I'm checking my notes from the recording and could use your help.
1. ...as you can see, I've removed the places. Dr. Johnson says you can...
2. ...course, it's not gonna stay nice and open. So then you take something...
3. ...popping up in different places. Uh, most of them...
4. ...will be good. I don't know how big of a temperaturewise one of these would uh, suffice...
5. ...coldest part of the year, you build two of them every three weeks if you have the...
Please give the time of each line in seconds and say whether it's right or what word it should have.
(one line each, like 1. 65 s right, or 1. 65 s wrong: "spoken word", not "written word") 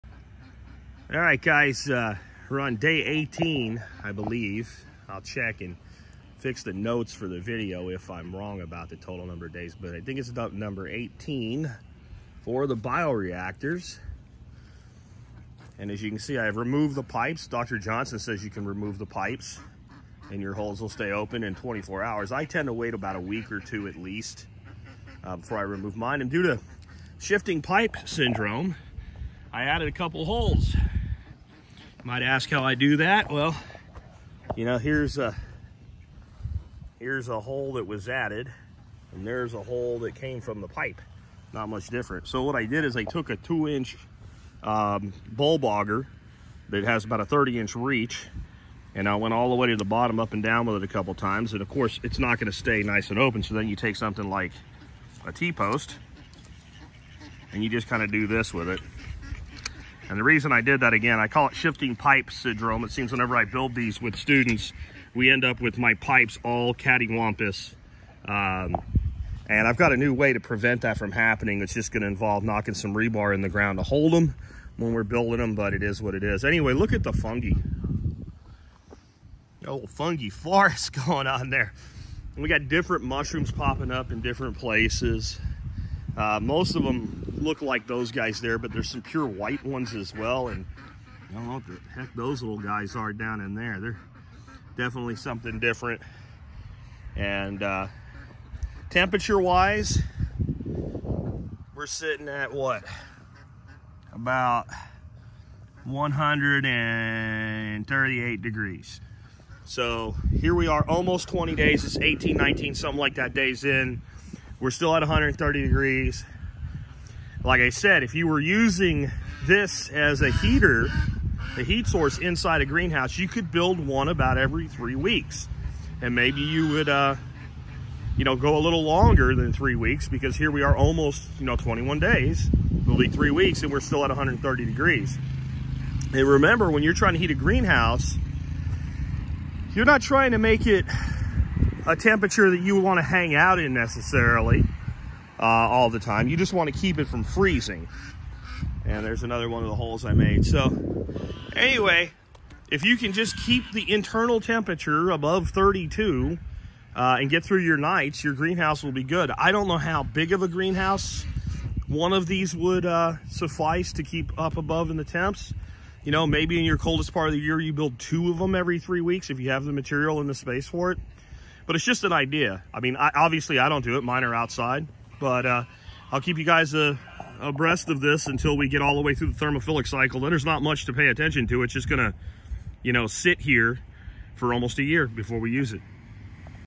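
1. 15 s wrong: "pipes", not "places"
2. 51 s right
3. 83 s right
4. 158 s wrong: "greenhouse", not "temperaturewise"
5. 166 s right.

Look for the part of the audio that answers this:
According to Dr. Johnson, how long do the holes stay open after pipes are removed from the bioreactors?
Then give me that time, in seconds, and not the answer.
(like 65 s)
21 s.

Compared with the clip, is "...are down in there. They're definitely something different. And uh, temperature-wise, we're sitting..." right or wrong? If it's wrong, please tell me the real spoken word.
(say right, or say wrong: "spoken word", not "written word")
right.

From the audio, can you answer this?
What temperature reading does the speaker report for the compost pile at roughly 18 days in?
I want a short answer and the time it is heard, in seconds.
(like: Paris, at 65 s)
138 degrees, at 105 s.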